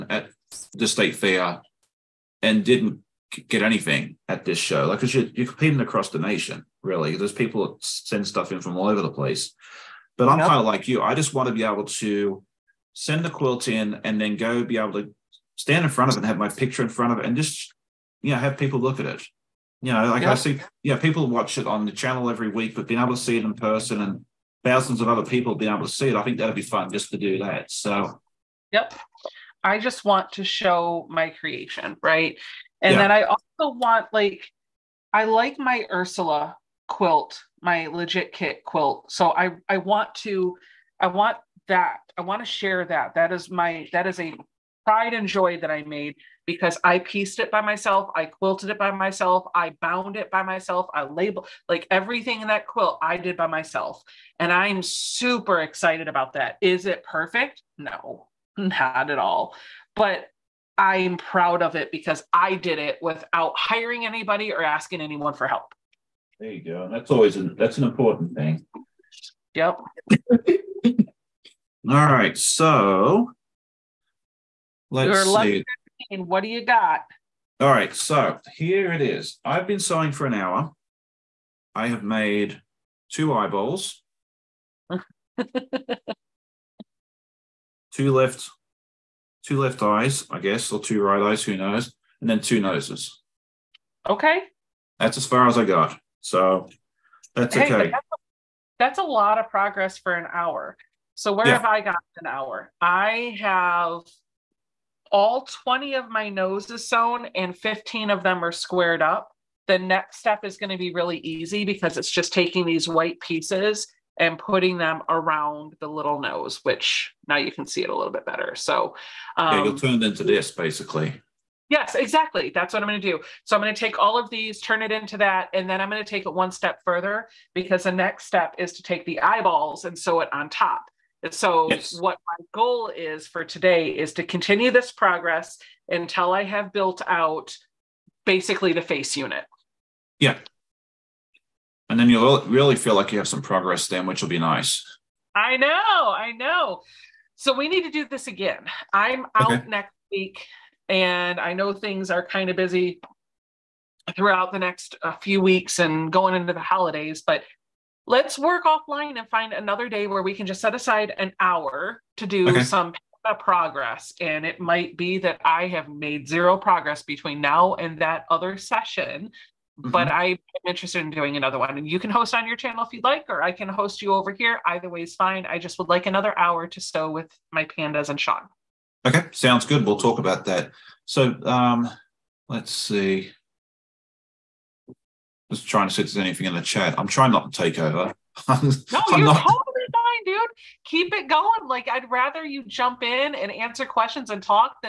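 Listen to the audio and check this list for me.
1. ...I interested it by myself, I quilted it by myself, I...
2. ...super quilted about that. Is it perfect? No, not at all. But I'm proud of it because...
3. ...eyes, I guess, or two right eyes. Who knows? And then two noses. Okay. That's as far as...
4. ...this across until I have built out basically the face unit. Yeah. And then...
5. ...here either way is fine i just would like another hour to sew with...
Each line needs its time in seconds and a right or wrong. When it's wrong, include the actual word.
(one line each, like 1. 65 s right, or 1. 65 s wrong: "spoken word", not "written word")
1. 46 s wrong: "pieced", not "interested"
2. 54 s wrong: "excited", not "quilted"
3. 89 s right
4. 134 s wrong: "progress", not "across"
5. 174 s right.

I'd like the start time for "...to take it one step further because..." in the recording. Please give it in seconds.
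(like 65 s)
126 s.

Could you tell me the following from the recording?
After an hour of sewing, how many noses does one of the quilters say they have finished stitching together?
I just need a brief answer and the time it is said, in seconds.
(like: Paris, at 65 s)
20, at 105 s.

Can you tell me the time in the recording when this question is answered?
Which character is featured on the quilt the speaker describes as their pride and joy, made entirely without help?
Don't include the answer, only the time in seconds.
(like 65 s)
35 s.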